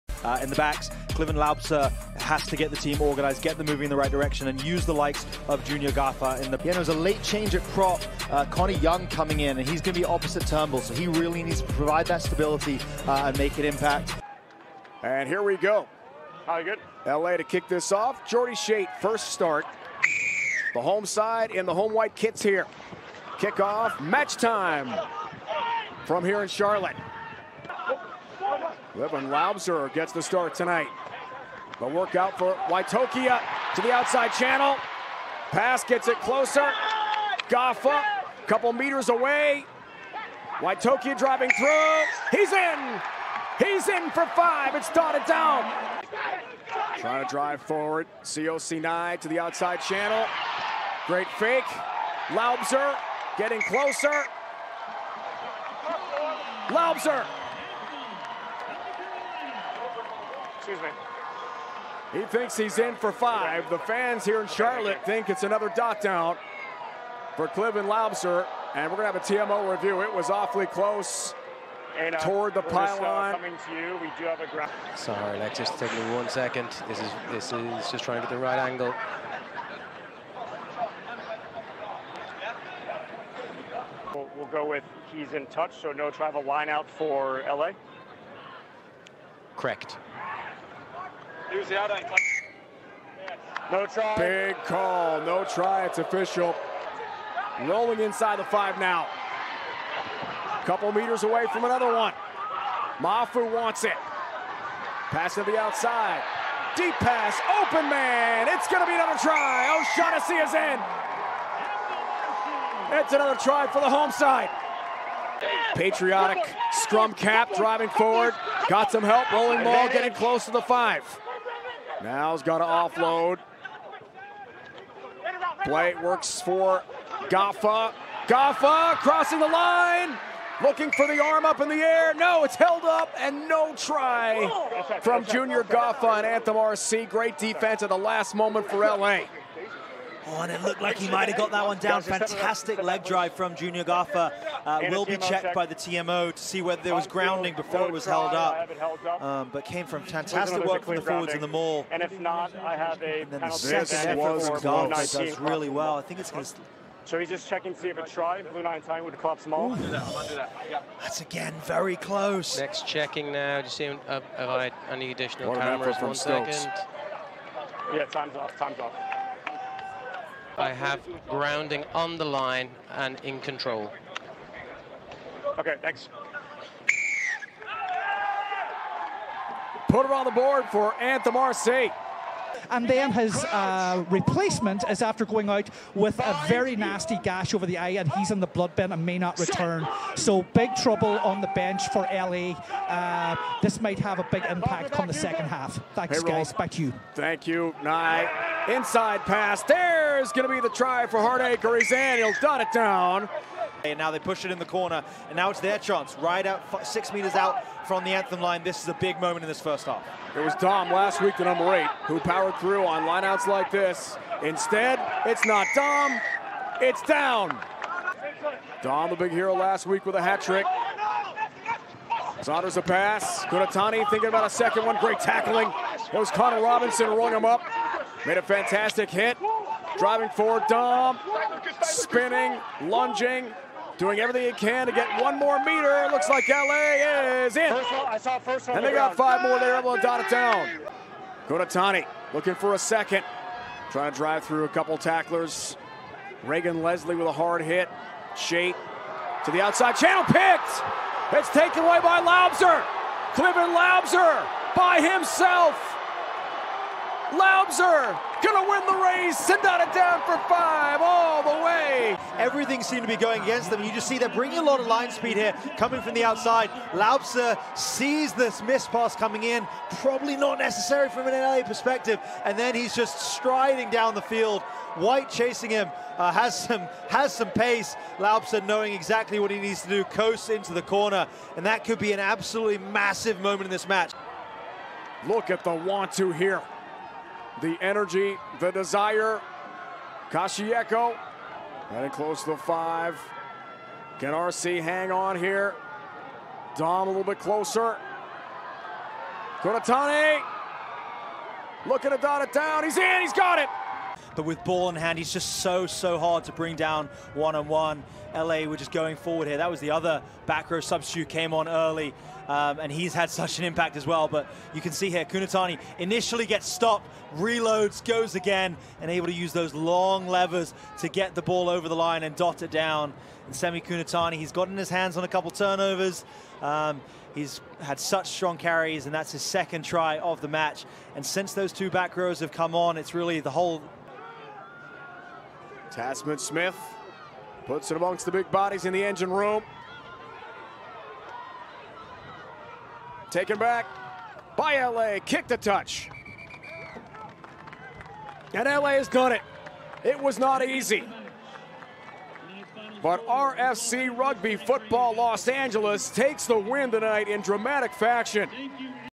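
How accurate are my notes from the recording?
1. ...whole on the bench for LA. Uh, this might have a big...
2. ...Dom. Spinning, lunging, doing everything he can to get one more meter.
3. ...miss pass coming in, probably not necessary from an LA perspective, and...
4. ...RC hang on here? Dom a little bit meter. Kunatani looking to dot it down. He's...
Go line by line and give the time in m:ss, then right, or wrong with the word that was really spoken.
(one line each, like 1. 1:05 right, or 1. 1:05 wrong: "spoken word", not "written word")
1. 3:10 wrong: "trouble", not "whole"
2. 3:50 right
3. 4:28 right
4. 4:54 wrong: "closer", not "meter".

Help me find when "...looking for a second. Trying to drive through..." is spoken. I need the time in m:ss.
4:02.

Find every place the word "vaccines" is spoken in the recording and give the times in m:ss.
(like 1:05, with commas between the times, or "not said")
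not said.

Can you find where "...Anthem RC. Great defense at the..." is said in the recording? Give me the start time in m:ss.
2:16.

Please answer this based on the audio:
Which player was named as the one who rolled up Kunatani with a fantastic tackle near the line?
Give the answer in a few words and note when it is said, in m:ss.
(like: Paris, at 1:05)
Connor Robinson, at 3:46.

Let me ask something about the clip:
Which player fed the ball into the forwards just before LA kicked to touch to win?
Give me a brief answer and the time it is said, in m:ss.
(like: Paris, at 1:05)
Tasman Smith, at 5:35.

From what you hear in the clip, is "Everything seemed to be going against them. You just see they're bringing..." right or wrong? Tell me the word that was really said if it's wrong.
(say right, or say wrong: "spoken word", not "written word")
right.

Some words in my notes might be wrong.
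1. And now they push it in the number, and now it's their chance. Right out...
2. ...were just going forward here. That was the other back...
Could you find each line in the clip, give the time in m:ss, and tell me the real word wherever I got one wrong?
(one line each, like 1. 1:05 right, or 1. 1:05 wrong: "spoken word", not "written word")
1. 3:23 wrong: "corner", not "number"
2. 5:08 right.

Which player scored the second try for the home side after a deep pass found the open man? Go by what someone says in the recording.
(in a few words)
O'Shaughnessy.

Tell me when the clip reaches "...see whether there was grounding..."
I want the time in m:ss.
2:26.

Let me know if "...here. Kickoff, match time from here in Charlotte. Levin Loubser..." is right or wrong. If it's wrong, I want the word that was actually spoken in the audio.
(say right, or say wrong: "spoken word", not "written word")
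right.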